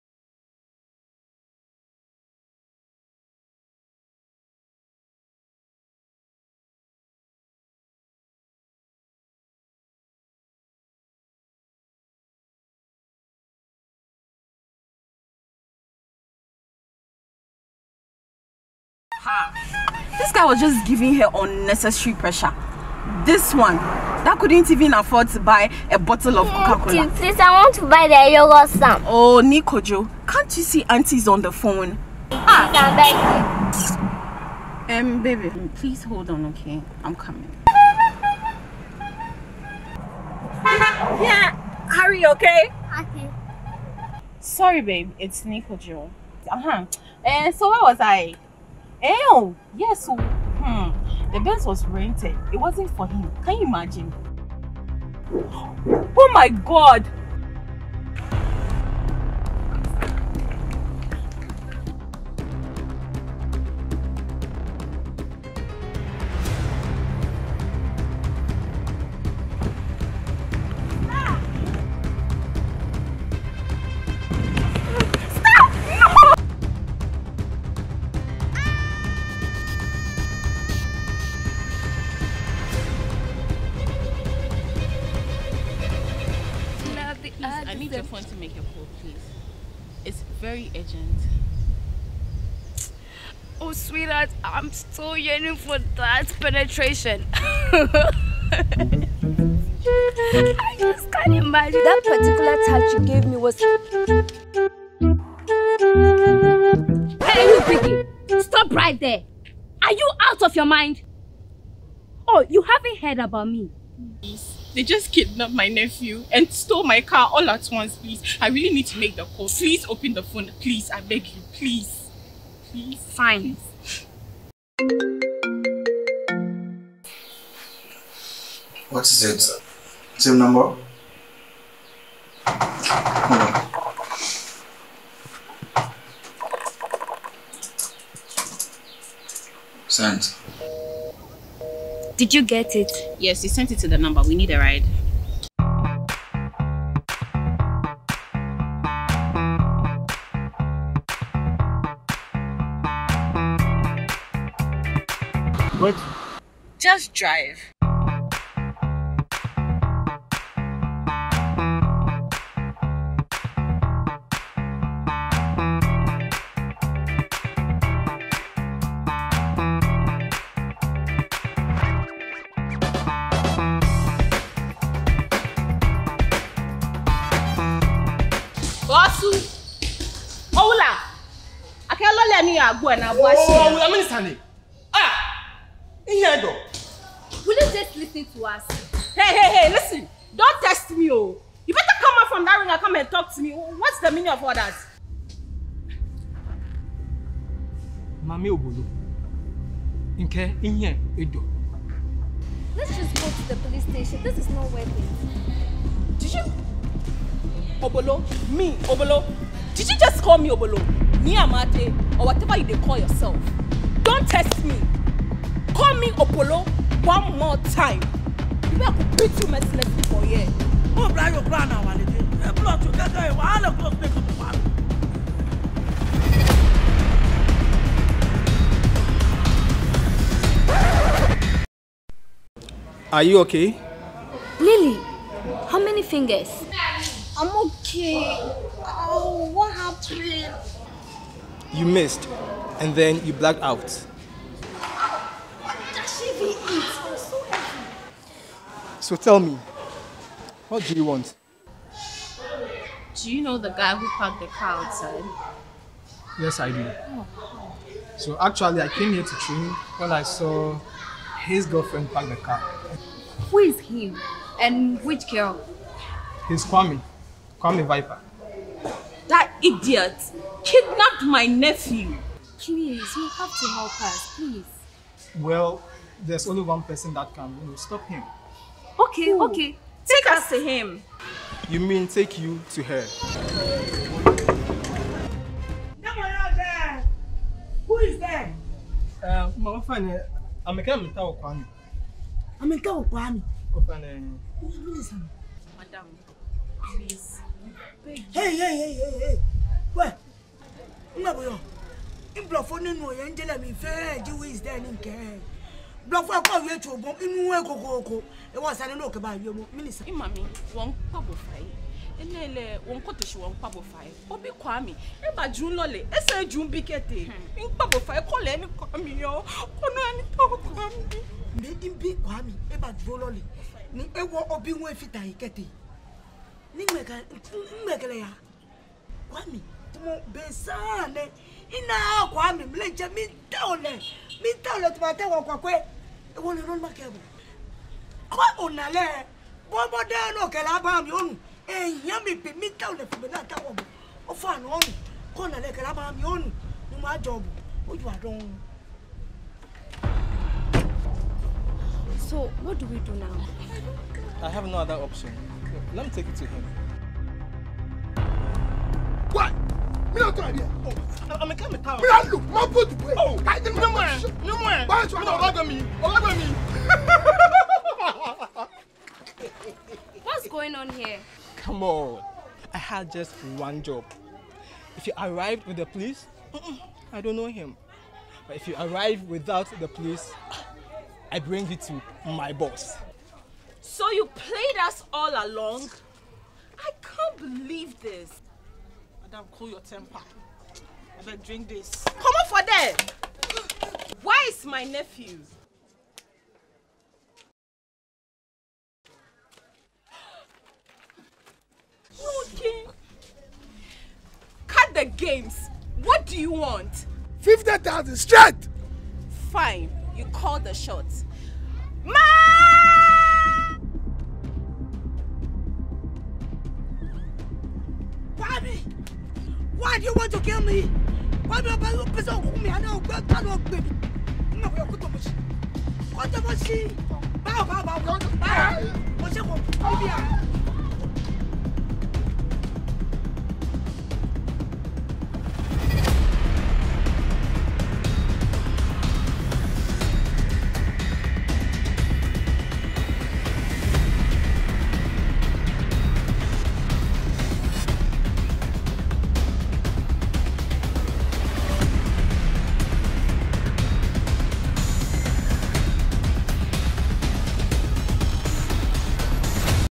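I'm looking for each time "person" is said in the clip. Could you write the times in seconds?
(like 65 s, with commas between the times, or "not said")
276 s.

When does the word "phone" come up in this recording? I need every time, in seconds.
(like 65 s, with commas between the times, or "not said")
31 s, 88 s, 120 s.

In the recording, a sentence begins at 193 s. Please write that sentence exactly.
What's the meaning of all that?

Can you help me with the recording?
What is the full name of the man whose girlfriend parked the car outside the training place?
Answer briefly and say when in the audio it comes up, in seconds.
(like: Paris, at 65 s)
Kwame Viper, at 267 s.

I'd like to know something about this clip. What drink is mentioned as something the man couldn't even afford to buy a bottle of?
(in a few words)
Coca-Cola.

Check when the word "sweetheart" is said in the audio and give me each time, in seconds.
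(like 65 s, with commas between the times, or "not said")
93 s.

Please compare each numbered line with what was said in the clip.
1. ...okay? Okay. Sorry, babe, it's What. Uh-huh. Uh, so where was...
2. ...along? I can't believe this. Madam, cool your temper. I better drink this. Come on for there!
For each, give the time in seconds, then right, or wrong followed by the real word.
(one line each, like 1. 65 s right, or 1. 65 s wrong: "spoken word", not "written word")
1. 42 s wrong: "Nikojo", not "What"
2. 385 s right.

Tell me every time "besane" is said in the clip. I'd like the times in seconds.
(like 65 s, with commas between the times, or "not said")
330 s.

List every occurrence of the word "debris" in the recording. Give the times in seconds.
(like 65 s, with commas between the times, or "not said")
not said.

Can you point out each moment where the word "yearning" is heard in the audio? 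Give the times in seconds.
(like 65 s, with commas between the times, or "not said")
95 s.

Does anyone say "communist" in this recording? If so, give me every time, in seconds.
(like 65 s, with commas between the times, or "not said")
not said.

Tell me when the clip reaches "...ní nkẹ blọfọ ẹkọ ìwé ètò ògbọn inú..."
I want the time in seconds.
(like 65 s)
304 s.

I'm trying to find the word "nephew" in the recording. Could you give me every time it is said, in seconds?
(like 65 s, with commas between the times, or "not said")
115 s, 271 s, 394 s.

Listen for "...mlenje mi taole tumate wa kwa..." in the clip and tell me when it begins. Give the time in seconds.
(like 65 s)
332 s.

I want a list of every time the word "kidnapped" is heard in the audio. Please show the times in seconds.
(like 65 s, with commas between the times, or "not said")
115 s, 270 s.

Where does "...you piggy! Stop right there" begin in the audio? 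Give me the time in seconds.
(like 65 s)
107 s.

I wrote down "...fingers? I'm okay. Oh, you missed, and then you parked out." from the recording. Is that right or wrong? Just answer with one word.
wrong.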